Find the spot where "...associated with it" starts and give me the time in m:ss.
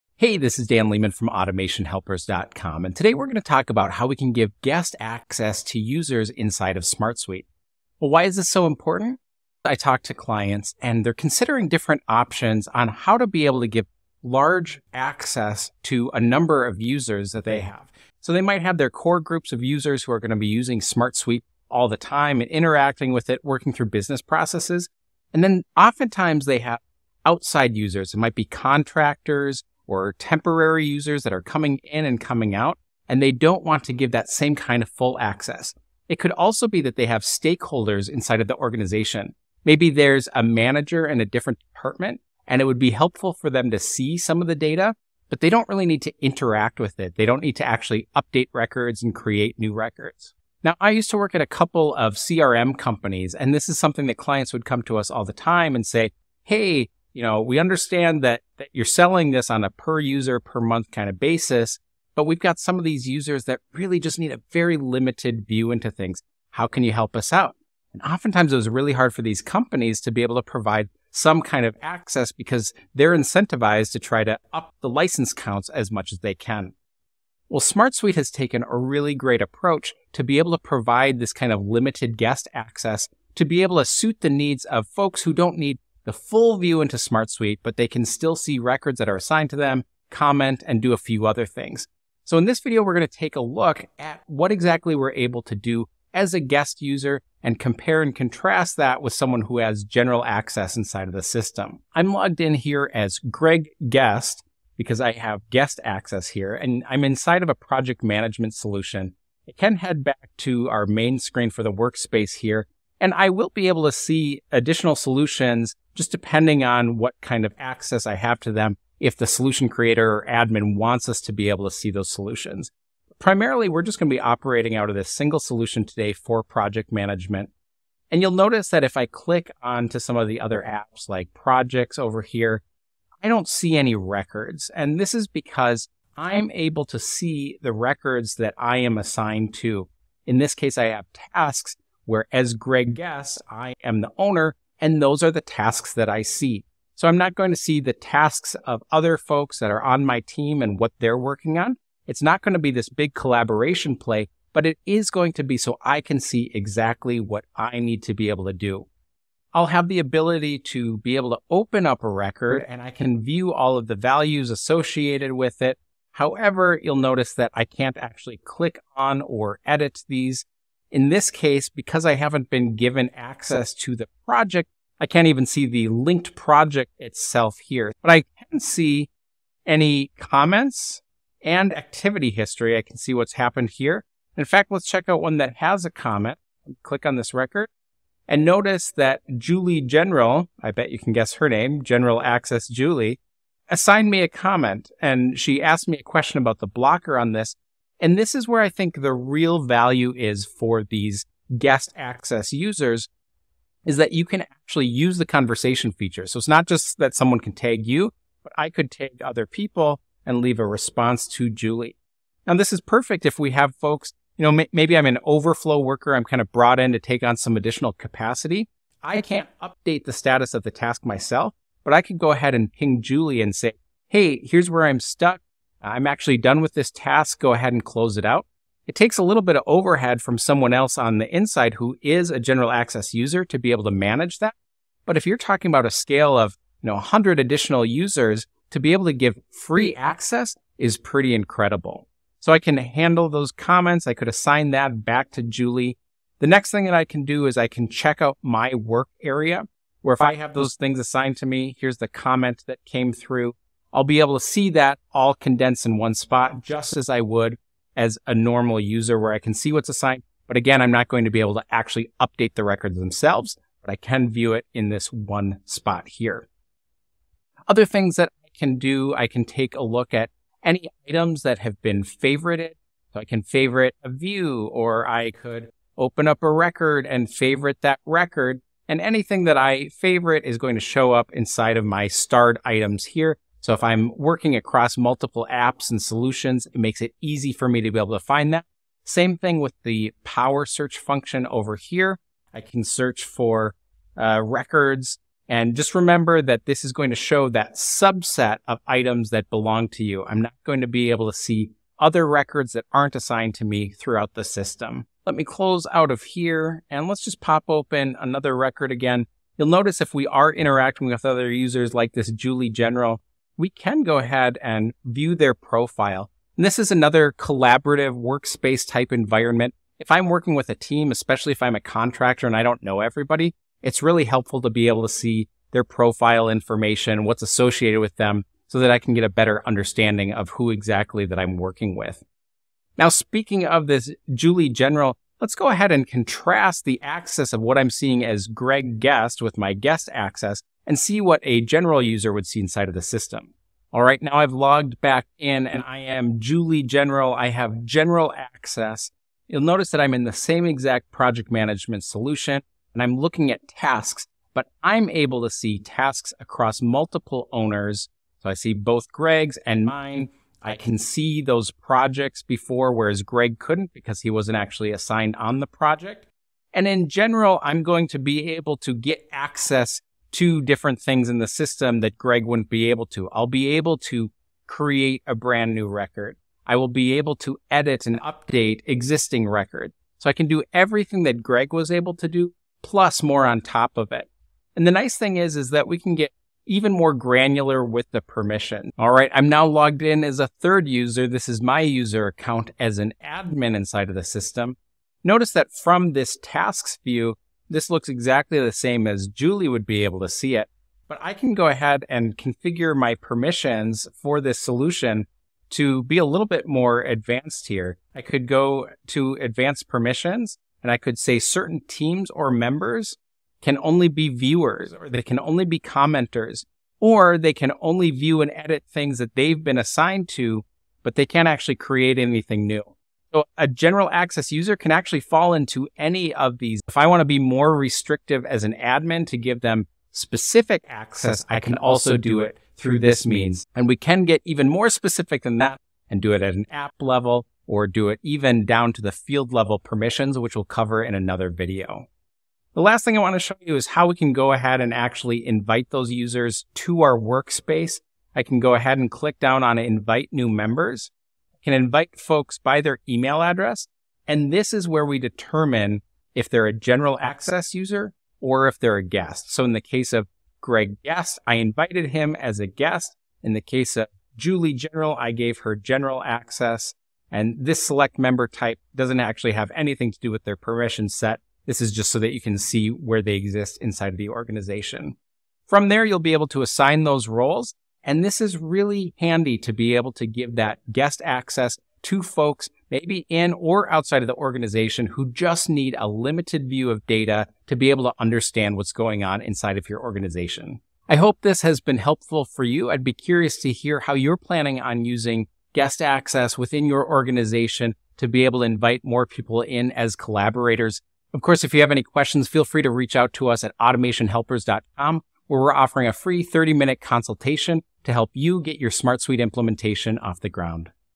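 2:44.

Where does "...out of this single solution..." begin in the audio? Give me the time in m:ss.
2:04.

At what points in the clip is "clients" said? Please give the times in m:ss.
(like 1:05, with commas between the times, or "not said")
0:10, 0:54.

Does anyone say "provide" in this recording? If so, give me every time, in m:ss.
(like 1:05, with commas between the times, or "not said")
1:10, 1:20.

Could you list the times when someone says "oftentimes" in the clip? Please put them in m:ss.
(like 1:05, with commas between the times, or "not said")
0:25, 1:08.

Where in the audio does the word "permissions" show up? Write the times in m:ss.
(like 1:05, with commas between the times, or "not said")
6:28, 6:43, 6:49, 7:19, 7:50.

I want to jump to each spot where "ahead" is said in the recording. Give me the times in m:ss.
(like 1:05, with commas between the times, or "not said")
3:42, 3:47, 5:14, 5:35, 6:41, 7:24, 7:28.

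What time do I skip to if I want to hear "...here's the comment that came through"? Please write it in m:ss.
4:11.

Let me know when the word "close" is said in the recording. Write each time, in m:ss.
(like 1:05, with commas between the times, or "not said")
3:47, 5:05.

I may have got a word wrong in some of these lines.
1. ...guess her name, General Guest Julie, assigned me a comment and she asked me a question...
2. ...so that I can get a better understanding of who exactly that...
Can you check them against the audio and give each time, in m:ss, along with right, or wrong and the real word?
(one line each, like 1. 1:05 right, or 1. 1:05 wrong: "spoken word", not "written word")
1. 3:11 wrong: "Access", not "Guest"
2. 5:28 right.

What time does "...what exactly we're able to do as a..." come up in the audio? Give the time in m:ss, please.
1:34.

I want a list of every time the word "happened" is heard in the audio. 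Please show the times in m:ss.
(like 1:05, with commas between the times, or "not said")
3:03.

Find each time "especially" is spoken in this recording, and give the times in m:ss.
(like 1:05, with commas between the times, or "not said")
5:21.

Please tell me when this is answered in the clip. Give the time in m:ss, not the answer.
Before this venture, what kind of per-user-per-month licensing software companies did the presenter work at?
0:52.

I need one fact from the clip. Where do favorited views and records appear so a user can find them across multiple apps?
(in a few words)
starred items.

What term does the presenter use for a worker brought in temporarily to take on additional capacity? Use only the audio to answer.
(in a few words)
overflow worker.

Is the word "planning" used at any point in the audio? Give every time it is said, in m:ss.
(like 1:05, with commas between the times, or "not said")
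8:14.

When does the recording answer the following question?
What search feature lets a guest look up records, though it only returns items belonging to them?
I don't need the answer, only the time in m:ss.
4:50.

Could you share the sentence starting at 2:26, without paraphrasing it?
So I'm not going to see the tasks of other folks that are on my team and what they're working on.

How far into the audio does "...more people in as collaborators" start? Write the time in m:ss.
8:19.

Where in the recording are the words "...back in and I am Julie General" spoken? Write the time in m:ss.
5:45.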